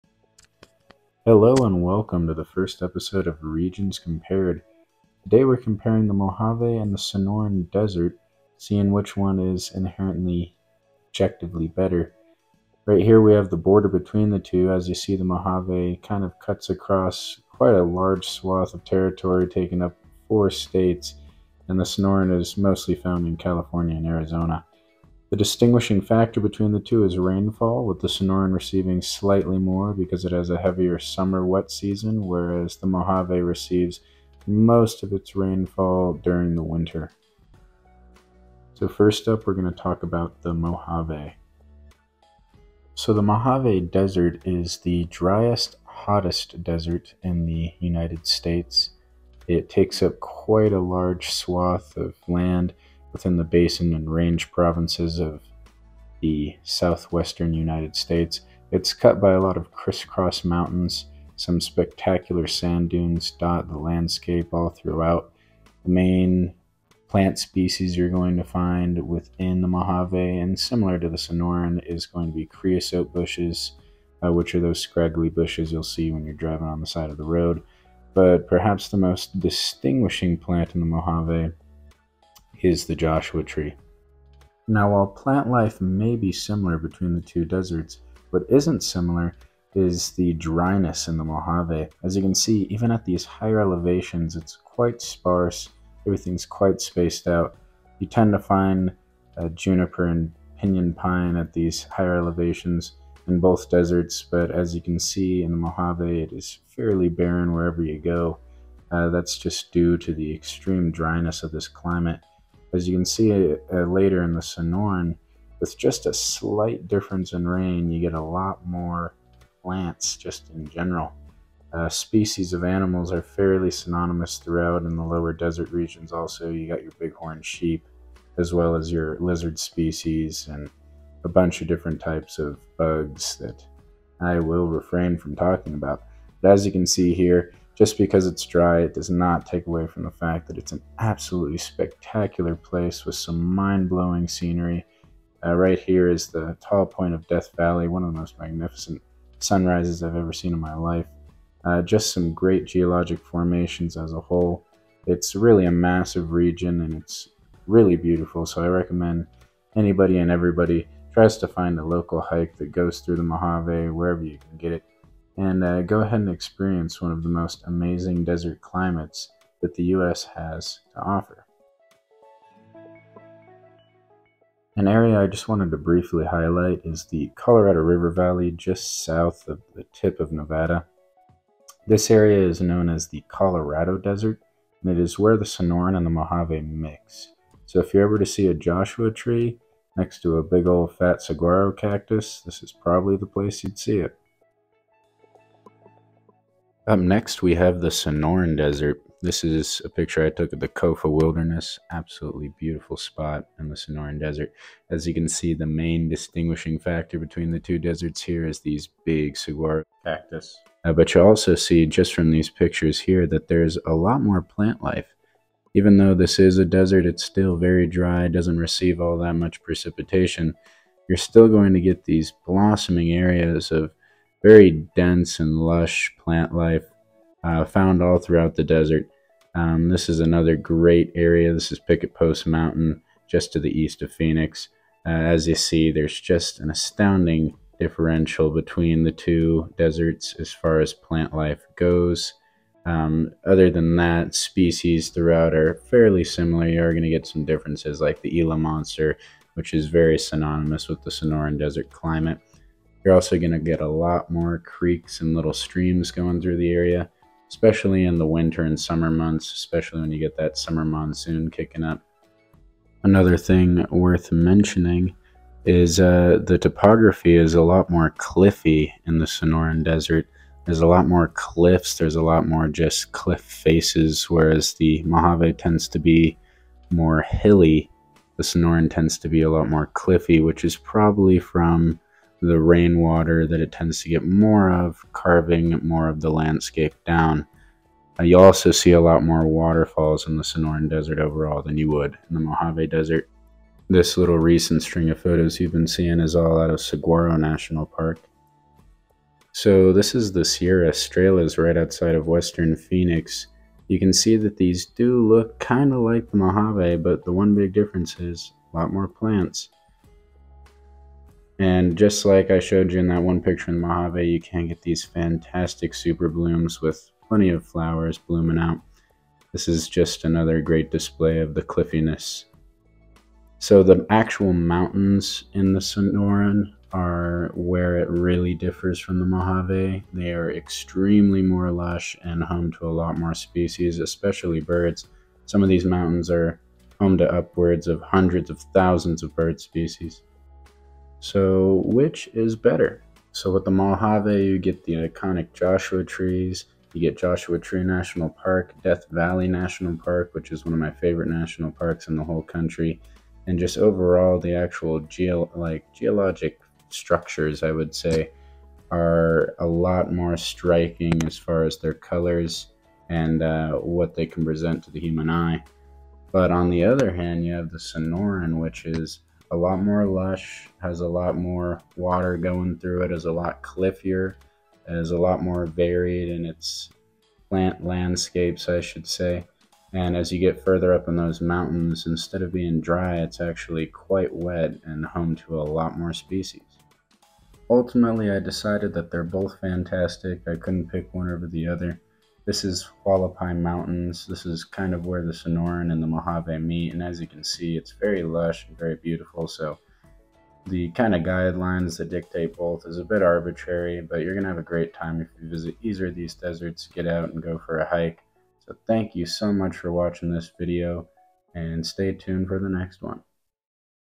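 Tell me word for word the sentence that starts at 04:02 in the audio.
Um, other than that, species throughout are fairly similar.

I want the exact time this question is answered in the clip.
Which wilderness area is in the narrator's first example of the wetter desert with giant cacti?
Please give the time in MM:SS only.
03:20.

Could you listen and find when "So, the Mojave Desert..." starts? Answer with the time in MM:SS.
00:42.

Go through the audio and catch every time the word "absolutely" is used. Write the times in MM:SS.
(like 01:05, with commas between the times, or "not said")
02:20, 03:21.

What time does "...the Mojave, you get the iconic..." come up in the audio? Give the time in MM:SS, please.
05:43.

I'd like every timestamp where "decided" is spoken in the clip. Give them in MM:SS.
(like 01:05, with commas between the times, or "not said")
06:28.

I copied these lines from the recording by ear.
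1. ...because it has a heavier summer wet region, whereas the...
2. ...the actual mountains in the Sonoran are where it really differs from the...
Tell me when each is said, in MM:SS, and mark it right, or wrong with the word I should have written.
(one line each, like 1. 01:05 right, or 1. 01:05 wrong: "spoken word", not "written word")
1. 00:29 wrong: "season", not "region"
2. 05:23 right.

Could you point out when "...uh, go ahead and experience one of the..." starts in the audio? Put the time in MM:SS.
02:45.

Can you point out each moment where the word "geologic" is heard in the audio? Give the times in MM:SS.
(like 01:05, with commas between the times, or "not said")
02:32, 05:55.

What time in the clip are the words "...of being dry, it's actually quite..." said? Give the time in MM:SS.
06:22.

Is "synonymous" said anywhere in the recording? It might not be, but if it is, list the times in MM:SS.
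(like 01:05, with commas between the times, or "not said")
02:03, 04:10.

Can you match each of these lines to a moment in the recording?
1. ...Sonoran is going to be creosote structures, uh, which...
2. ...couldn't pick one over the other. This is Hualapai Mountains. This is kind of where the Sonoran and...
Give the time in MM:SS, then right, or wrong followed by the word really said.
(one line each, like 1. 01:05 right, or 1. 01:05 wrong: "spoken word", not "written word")
1. 01:11 wrong: "bushes", not "structures"
2. 06:30 right.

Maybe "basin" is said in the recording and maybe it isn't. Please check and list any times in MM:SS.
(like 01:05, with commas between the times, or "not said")
00:53.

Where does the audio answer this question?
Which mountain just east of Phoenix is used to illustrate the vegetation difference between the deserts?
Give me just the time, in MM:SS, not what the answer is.
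03:51.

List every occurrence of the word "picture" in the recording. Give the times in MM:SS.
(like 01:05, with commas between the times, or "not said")
03:19, 03:32, 05:13.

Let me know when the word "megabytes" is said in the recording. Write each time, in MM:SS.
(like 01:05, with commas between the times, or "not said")
not said.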